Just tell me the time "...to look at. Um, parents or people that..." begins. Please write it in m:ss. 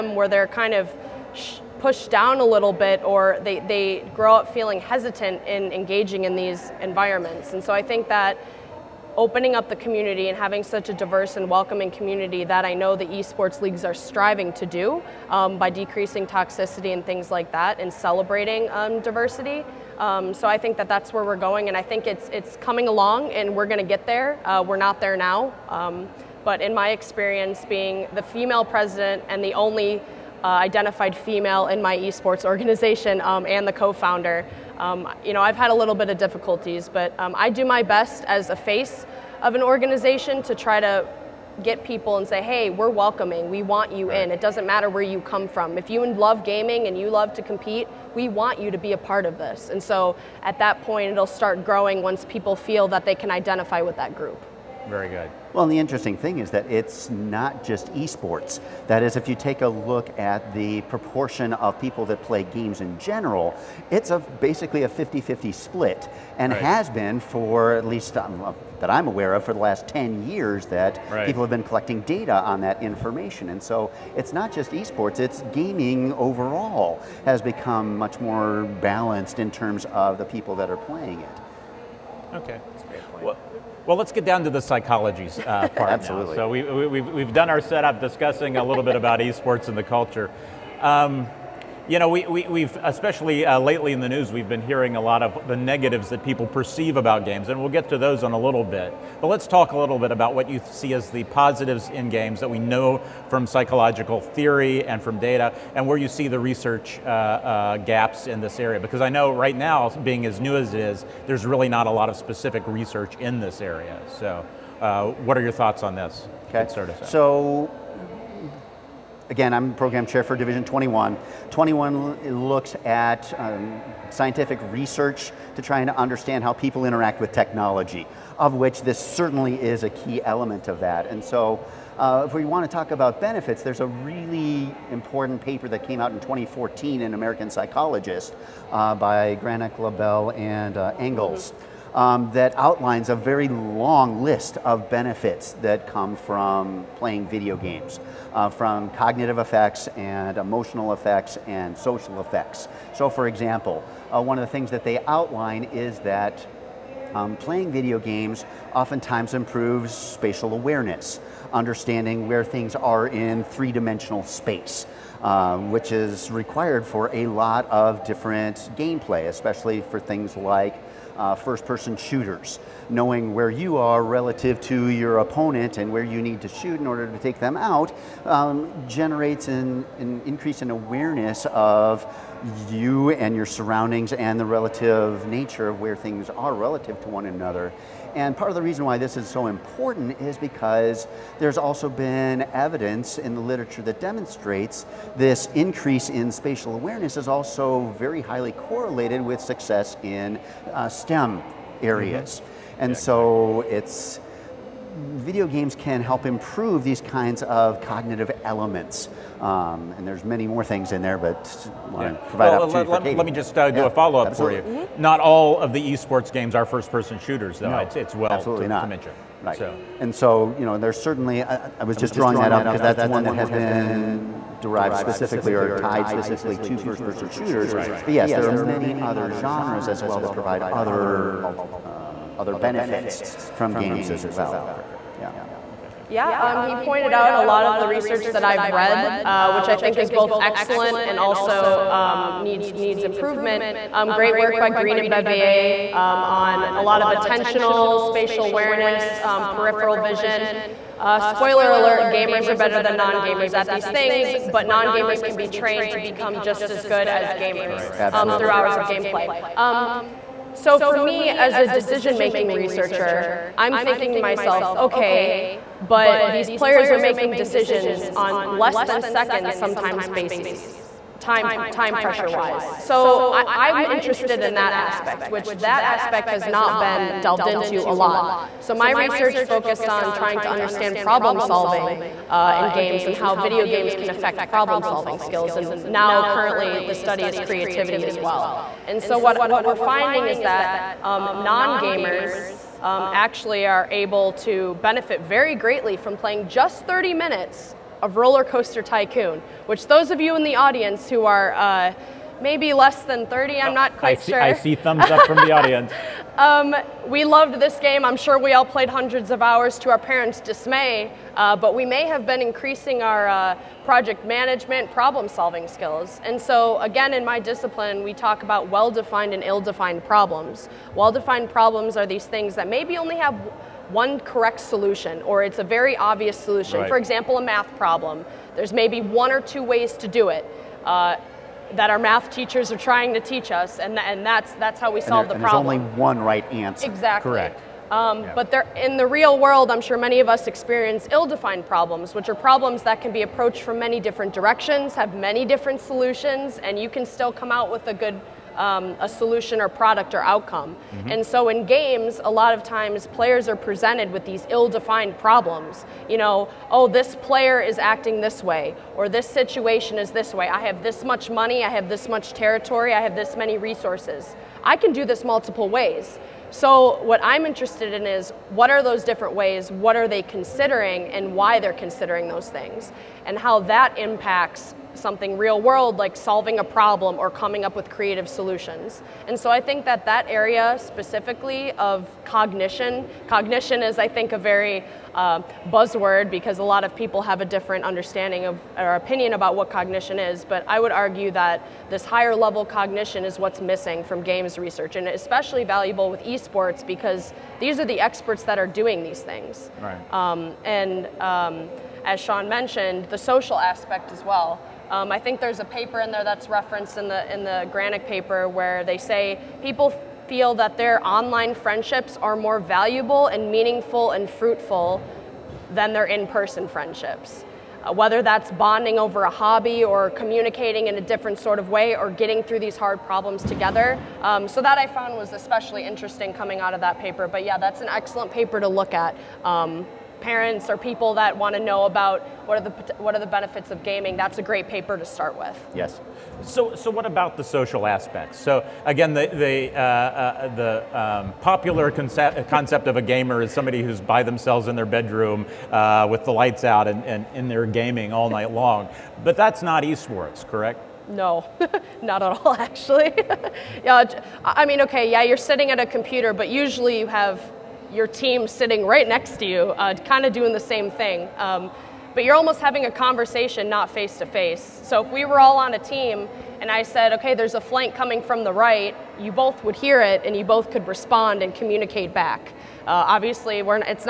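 7:08.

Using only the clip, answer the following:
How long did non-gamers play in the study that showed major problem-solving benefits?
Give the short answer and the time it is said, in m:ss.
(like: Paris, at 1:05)
30 minutes, at 4:56.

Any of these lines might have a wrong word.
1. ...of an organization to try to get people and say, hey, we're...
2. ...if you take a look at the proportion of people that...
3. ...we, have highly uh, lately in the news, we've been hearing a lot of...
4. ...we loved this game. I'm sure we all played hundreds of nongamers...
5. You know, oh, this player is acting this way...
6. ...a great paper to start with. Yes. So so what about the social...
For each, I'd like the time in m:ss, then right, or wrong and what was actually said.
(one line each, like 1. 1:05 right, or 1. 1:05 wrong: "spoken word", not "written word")
1. 0:39 right
2. 0:59 right
3. 1:32 wrong: "especially", not "highly"
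4. 5:07 wrong: "hours", not "nongamers"
5. 5:56 right
6. 7:14 right.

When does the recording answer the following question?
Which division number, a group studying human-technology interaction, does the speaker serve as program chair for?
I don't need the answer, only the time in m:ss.
2:00.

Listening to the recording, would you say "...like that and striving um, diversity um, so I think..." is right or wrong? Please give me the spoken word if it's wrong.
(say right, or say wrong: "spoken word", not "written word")
wrong: "celebrating", not "striving".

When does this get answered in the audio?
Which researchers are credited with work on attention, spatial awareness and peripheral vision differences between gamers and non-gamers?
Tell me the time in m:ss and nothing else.
4:04.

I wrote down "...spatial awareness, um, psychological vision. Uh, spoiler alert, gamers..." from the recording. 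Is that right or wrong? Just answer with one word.
wrong.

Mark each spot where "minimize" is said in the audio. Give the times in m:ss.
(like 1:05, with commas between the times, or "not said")
not said.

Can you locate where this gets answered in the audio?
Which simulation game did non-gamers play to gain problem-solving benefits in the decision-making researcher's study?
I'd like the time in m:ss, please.
4:58.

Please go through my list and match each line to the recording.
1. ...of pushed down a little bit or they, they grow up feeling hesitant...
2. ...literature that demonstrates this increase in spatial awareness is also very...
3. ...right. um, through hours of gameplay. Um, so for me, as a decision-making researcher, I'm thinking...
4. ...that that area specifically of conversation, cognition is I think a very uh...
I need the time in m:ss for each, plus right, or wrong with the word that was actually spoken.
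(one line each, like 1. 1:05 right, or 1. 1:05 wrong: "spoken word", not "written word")
1. 0:00 right
2. 3:13 right
3. 4:17 right
4. 6:19 wrong: "cognition", not "conversation".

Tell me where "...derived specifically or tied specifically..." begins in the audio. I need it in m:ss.
3:44.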